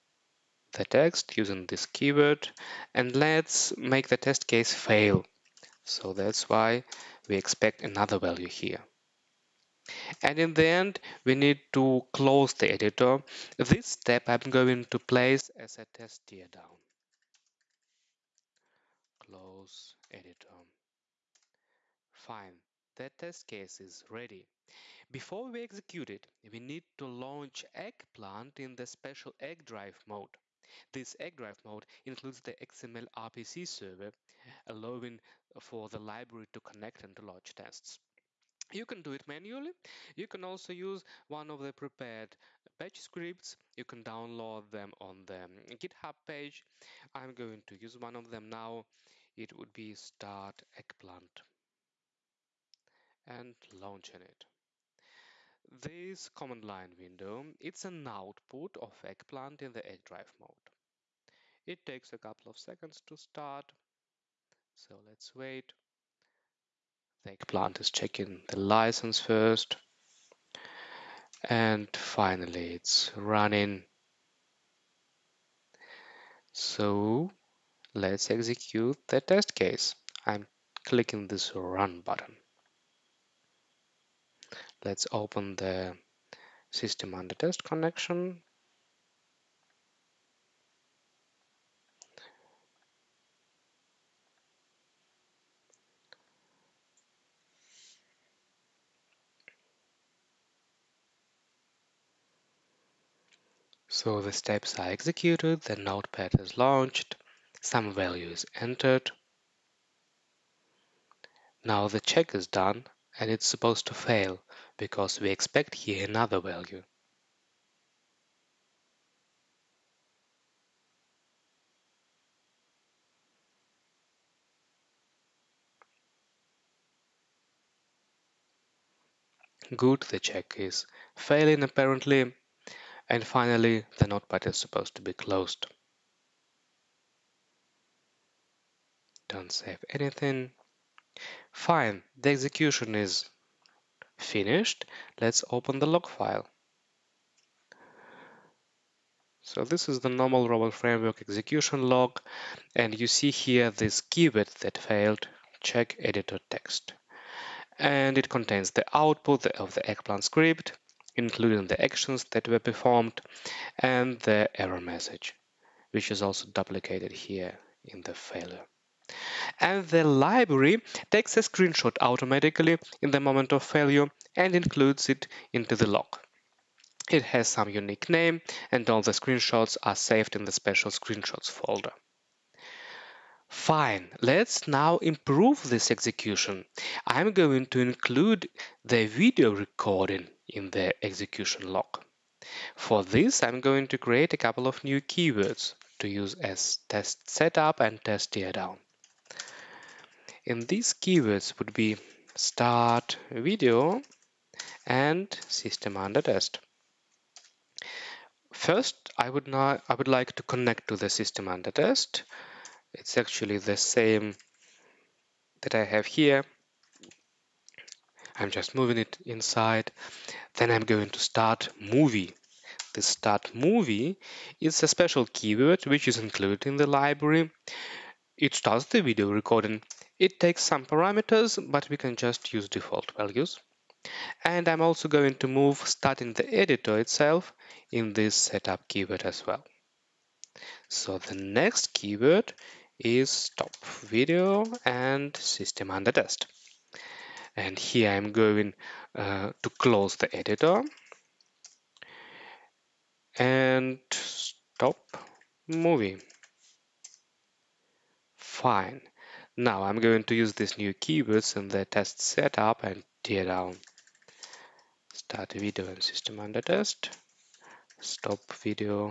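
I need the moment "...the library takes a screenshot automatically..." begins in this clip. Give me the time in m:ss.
2:49.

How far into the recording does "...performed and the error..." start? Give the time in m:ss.
2:42.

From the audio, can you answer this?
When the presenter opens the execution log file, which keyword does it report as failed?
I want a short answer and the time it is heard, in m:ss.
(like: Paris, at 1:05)
check editor text, at 2:35.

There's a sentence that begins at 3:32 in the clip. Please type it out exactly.
It's actually the same that I have here.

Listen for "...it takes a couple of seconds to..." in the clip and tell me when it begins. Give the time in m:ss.
1:01.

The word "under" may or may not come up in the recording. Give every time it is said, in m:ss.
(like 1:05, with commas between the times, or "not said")
1:27, 3:25, 3:31, 4:05, 4:26.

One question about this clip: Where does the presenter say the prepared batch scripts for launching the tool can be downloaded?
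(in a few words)
GitHub page.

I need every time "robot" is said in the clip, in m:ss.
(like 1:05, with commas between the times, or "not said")
2:30.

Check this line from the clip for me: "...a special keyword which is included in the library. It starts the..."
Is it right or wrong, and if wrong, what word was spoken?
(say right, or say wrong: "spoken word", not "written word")
right.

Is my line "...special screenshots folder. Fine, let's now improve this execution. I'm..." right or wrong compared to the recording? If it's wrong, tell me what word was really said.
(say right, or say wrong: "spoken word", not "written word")
right.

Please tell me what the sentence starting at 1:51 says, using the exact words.
Now the check is done and it's supposed to fail because we expect here another value.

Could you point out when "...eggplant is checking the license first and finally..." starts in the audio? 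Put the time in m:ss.
1:07.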